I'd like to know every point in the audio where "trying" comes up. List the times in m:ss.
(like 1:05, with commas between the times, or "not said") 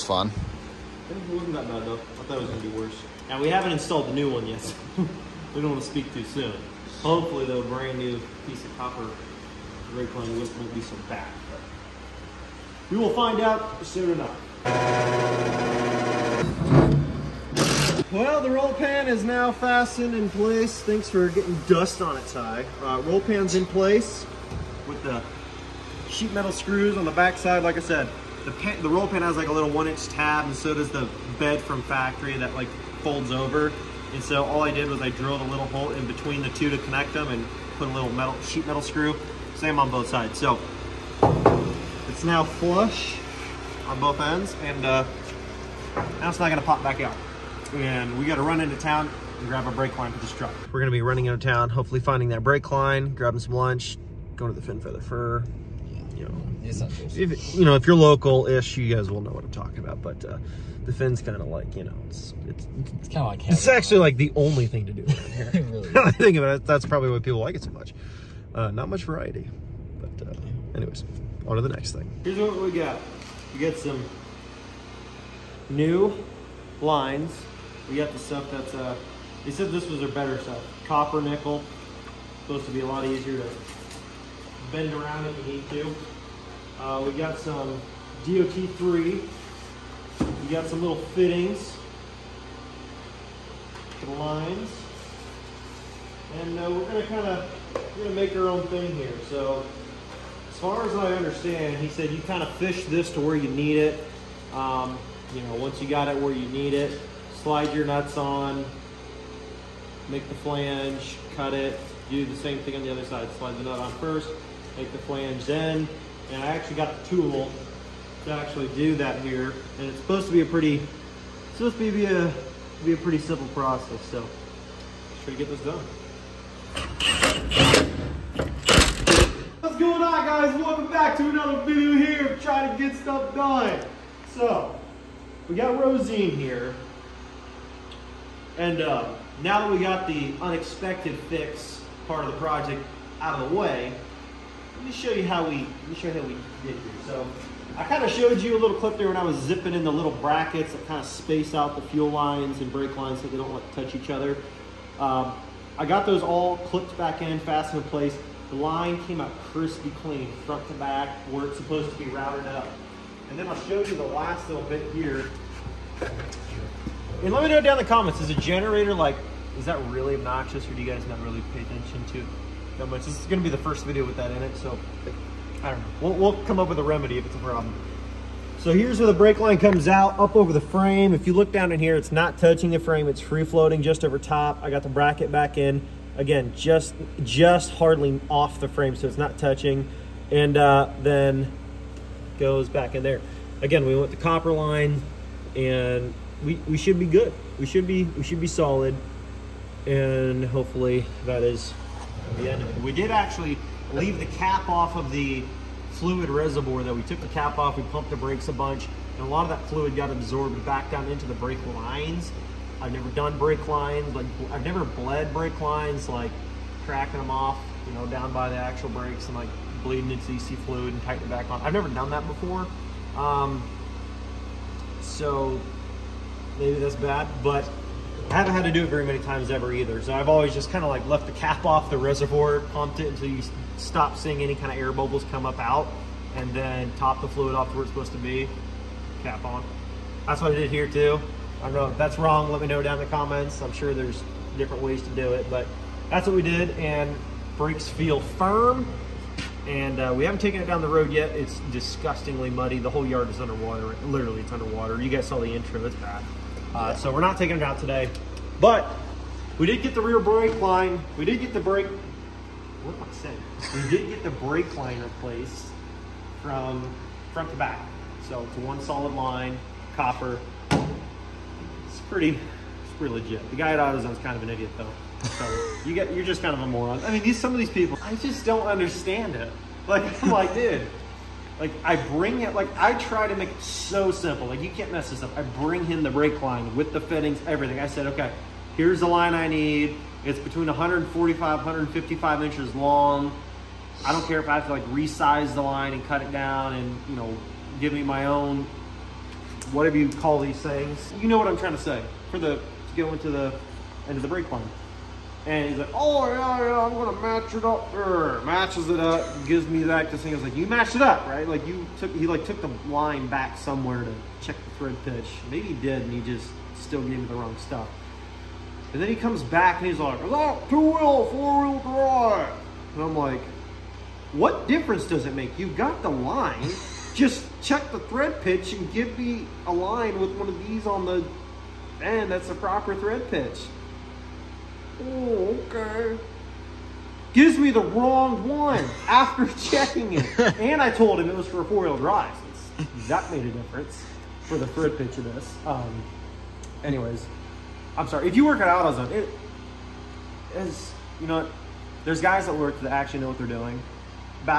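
2:12, 5:01.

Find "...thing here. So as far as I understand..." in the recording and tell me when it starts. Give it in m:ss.
1:38.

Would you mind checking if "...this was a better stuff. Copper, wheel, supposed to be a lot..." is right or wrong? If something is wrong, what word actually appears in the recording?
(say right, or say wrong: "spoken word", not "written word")
wrong: "nickel", not "wheel".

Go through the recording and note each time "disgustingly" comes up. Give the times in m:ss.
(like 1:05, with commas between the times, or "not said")
4:11.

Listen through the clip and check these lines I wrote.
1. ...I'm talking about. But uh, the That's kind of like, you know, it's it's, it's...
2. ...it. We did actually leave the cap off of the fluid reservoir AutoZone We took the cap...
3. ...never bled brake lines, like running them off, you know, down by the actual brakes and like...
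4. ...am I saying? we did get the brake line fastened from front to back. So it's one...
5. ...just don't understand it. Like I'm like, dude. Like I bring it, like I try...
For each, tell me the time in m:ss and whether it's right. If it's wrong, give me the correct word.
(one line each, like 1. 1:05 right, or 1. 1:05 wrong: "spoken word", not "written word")
1. 0:59 wrong: "Fin", not "That"
2. 3:22 wrong: "That", not "AutoZone"
3. 3:34 wrong: "cracking", not "running"
4. 4:22 wrong: "replaced", not "fastened"
5. 4:38 right.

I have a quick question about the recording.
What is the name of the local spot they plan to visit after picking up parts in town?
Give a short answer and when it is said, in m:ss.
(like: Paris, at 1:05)
Fin Feather Fur, at 0:54.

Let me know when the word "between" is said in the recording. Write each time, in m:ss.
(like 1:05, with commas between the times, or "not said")
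0:36, 4:50.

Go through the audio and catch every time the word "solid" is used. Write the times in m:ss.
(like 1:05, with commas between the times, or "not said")
3:18, 4:28.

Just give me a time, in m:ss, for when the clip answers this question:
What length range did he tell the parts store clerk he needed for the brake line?
4:50.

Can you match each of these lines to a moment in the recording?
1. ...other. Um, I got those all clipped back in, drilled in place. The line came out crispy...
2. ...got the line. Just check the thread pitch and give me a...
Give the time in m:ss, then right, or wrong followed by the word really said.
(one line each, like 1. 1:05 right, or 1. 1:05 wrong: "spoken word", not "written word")
1. 2:34 wrong: "fastened", not "drilled"
2. 5:25 right.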